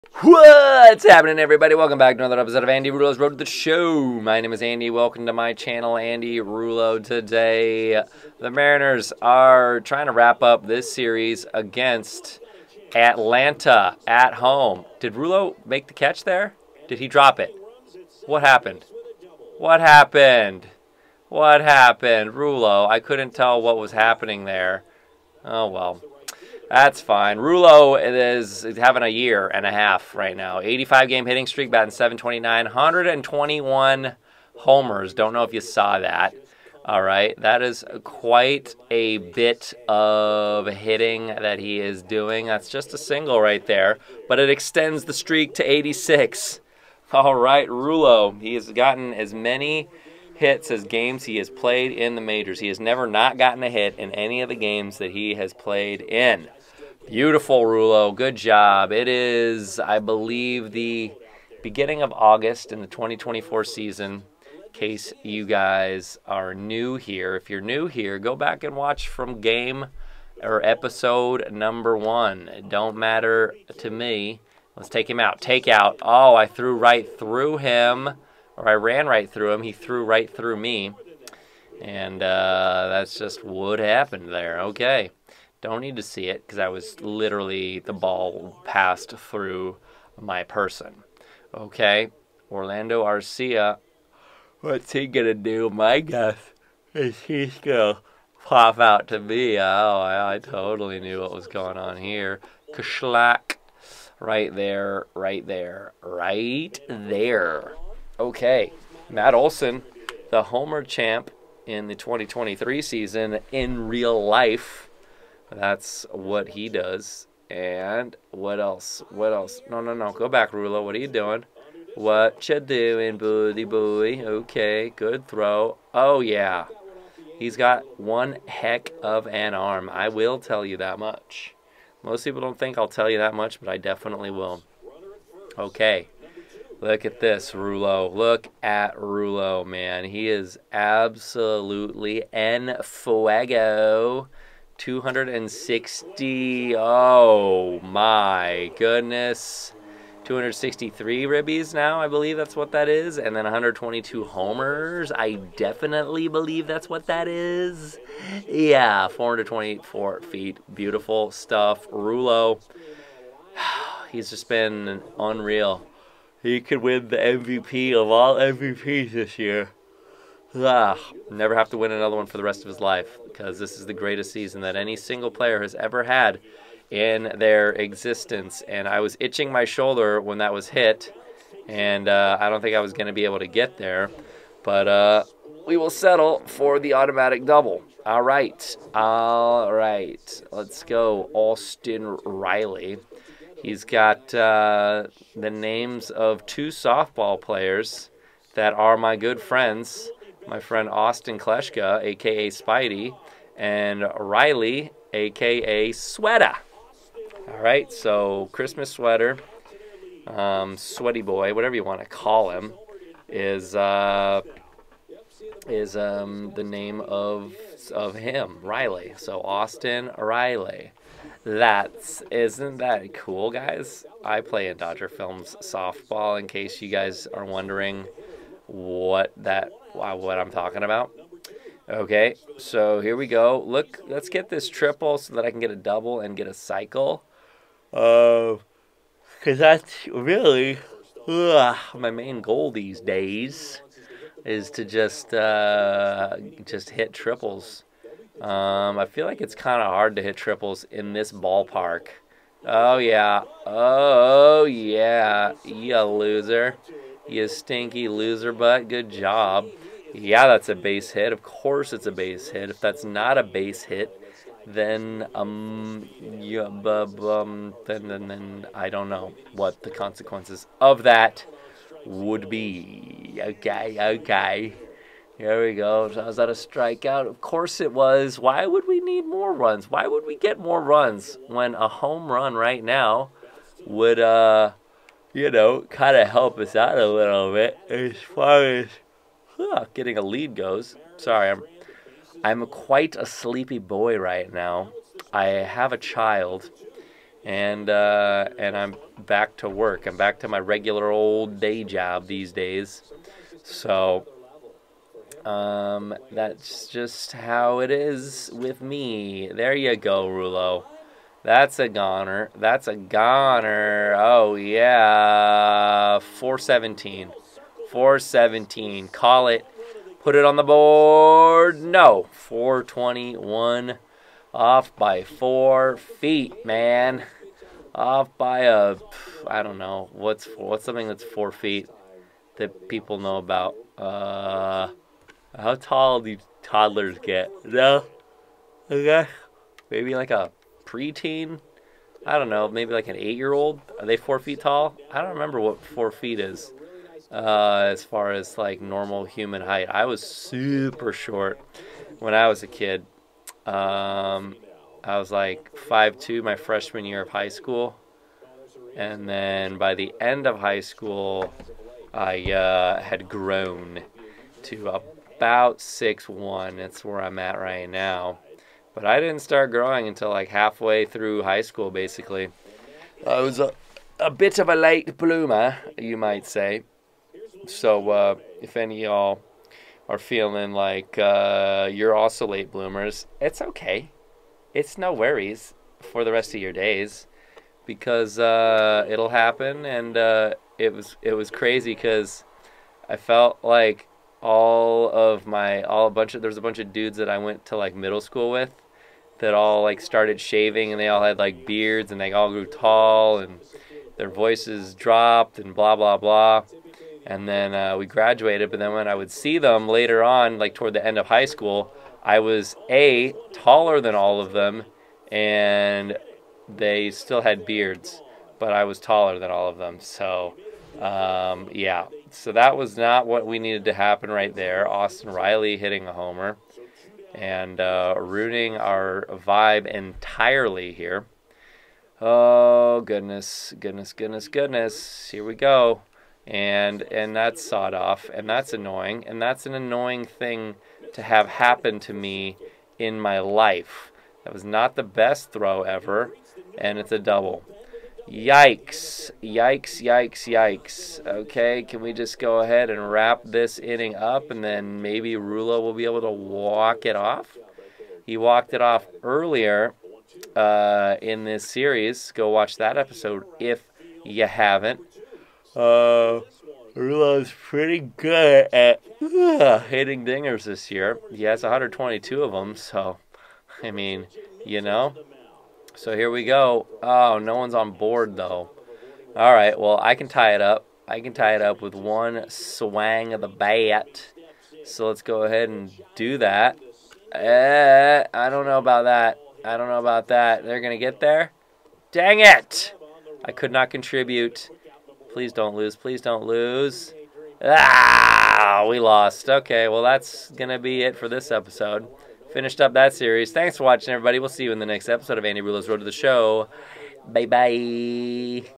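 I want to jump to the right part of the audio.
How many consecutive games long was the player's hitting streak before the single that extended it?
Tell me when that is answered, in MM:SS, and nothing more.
00:30.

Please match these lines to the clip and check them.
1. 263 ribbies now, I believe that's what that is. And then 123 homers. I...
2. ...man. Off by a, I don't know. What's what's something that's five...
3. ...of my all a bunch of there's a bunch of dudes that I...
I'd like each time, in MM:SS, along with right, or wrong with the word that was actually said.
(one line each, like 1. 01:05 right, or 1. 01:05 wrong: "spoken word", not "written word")
1. 02:30 wrong: "122", not "123"
2. 05:26 wrong: "four", not "five"
3. 06:35 right.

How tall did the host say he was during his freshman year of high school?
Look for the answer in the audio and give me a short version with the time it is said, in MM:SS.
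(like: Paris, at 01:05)
5'2, at 05:55.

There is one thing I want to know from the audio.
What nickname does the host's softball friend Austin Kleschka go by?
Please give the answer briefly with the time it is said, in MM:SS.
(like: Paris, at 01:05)
Spidey, at 03:22.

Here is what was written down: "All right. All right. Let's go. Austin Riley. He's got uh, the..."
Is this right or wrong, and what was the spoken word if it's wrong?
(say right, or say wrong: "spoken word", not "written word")
right.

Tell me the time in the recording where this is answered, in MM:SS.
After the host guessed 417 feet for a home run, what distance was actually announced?
05:22.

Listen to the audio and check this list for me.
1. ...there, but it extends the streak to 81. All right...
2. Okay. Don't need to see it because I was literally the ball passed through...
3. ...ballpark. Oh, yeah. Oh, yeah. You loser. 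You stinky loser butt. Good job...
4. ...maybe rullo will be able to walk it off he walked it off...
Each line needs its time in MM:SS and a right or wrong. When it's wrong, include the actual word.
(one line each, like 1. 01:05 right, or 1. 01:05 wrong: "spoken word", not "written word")
1. 00:43 wrong: "86", not "81"
2. 01:24 right
3. 04:11 right
4. 07:35 right.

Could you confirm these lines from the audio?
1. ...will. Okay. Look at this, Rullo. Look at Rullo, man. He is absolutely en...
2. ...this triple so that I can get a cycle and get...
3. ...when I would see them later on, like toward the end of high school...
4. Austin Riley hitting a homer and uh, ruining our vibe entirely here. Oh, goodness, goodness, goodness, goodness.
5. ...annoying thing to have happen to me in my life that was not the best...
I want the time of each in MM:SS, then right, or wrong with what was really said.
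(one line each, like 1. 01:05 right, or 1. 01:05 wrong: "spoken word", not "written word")
1. 02:14 right
2. 03:54 wrong: "double", not "cycle"
3. 06:48 right
4. 07:04 right
5. 07:19 right.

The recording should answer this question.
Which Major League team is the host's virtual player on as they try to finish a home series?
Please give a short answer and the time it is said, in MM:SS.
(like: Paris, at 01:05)
Mariners, at 00:08.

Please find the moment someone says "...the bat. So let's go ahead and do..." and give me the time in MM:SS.
08:03.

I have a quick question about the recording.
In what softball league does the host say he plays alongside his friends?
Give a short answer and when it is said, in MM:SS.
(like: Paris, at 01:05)
Dodger Films softball, at 03:44.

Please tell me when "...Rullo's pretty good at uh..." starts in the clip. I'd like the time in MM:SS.
07:46.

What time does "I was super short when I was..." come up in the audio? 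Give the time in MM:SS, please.
05:49.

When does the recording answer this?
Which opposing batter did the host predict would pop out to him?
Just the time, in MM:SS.
01:32.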